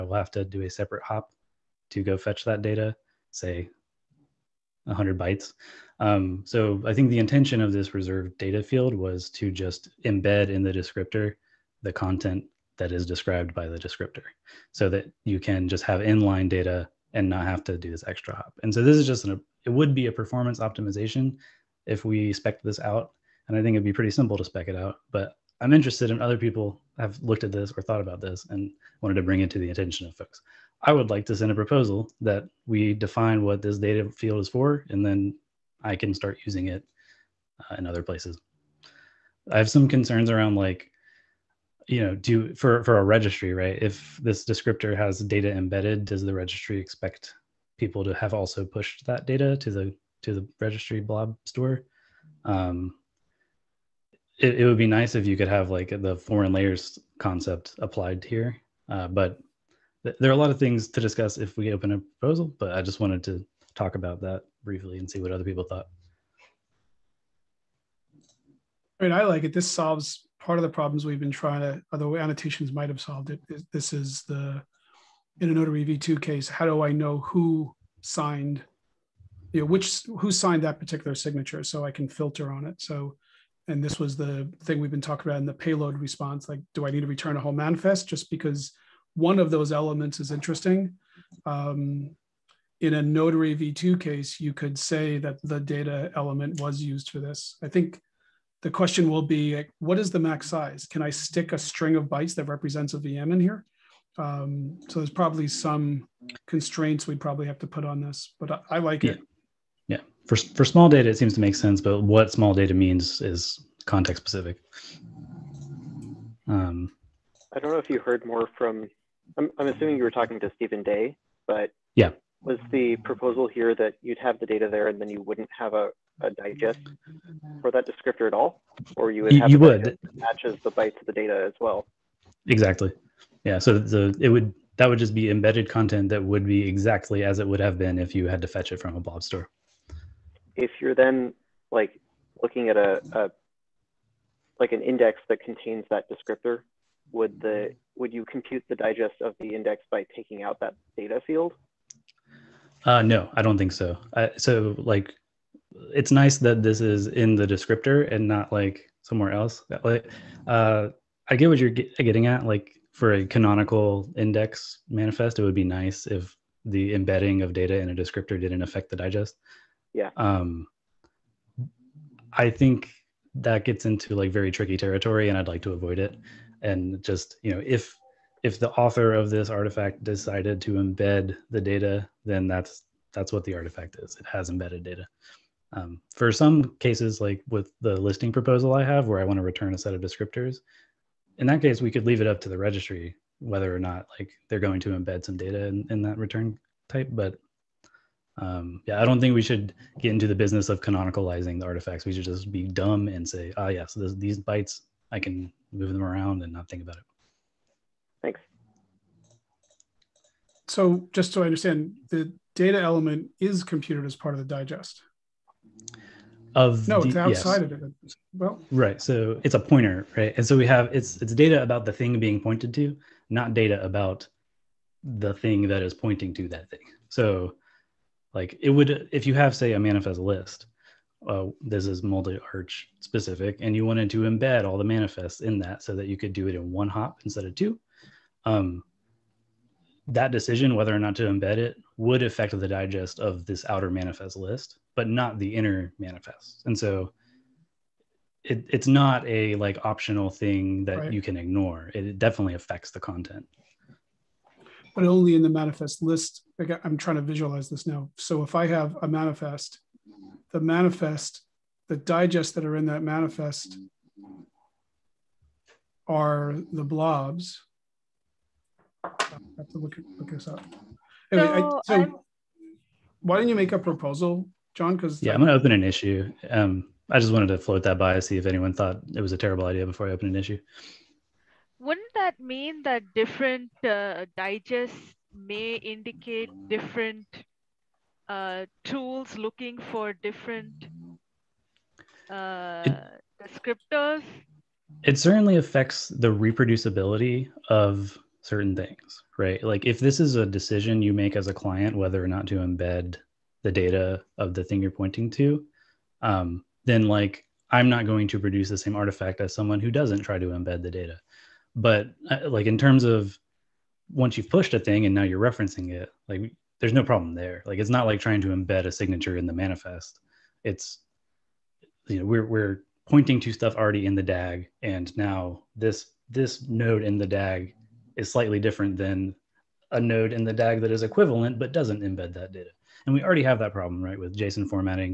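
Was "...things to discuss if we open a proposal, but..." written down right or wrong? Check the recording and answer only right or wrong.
right.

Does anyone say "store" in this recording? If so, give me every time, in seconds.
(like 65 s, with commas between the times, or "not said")
51 s, 139 s.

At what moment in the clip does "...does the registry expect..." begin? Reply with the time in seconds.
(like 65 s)
46 s.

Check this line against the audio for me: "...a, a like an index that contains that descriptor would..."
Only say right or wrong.
right.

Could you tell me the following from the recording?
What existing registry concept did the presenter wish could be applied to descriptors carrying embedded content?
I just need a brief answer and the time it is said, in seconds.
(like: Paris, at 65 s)
foreign layers, at 56 s.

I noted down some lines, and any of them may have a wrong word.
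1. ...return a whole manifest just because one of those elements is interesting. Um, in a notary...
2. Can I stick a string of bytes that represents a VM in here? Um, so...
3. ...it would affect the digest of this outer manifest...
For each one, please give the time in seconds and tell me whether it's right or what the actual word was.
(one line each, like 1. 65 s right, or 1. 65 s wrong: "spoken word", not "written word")
1. 87 s right
2. 100 s right
3. 241 s right.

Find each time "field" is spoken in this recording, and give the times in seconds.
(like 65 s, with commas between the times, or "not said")
8 s, 34 s, 151 s.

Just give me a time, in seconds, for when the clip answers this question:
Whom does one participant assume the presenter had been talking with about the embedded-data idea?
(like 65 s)
120 s.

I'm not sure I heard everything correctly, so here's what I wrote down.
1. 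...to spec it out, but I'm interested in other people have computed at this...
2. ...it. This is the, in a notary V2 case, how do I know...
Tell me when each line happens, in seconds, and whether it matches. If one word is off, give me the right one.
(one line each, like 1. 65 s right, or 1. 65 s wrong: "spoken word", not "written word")
1. 24 s wrong: "looked", not "computed"
2. 73 s right.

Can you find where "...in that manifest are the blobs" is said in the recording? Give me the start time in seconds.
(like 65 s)
262 s.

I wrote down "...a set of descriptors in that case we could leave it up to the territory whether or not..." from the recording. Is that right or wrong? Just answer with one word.
wrong.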